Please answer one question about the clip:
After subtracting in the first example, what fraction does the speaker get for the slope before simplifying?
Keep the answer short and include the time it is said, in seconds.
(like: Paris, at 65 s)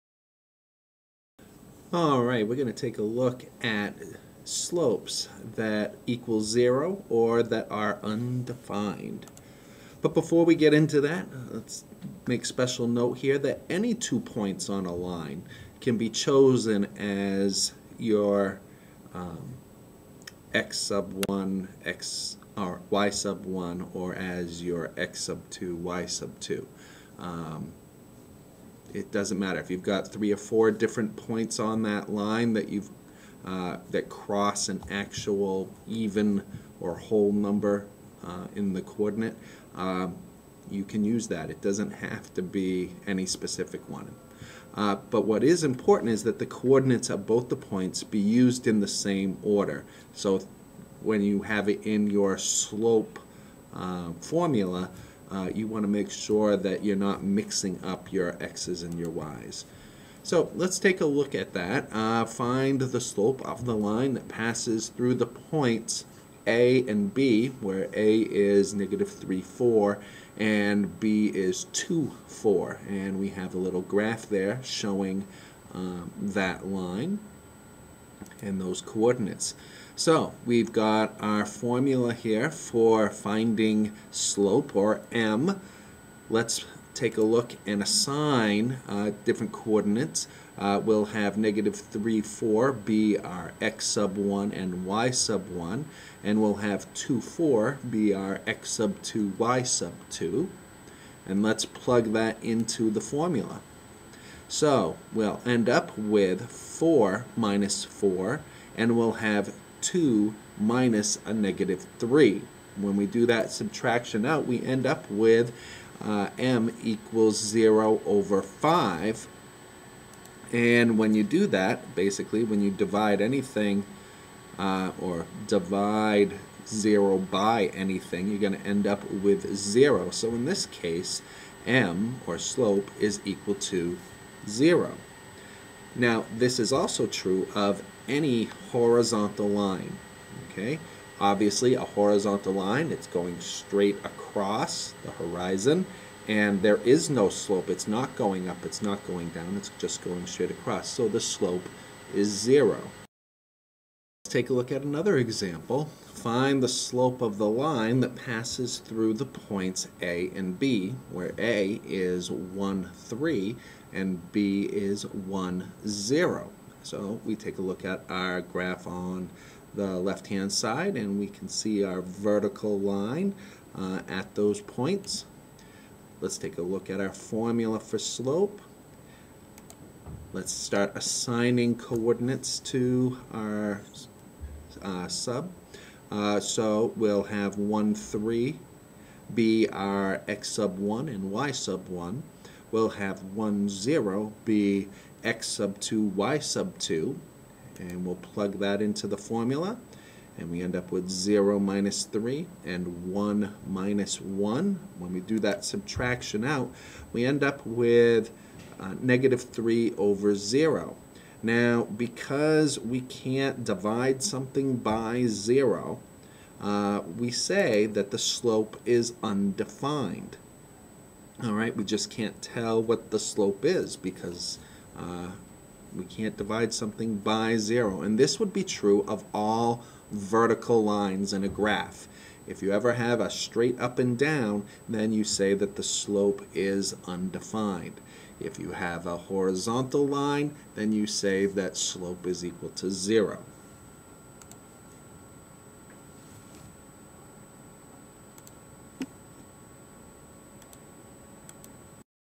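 0 over 5, at 117 s.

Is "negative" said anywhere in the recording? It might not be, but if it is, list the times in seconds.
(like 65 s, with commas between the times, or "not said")
68 s, 91 s, 111 s, 209 s.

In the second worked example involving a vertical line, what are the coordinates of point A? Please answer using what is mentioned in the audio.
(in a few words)
1, 3.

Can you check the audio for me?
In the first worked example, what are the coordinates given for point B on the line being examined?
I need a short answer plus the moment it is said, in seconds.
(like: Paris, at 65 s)
2, 4, at 70 s.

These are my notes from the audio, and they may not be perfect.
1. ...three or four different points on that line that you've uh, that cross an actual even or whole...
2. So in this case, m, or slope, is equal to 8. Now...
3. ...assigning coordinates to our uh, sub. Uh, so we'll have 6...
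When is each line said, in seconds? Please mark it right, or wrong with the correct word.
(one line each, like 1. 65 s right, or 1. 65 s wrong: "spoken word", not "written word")
1. 30 s right
2. 130 s wrong: "0", not "8"
3. 180 s wrong: "1", not "6".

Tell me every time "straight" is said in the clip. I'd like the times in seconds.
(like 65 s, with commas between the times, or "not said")
143 s, 150 s, 233 s.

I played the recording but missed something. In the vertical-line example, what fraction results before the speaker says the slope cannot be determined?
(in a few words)
-3 over 0.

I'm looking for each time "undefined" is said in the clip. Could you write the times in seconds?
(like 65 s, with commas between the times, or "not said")
8 s, 219 s, 237 s.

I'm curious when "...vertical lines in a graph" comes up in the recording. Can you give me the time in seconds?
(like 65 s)
230 s.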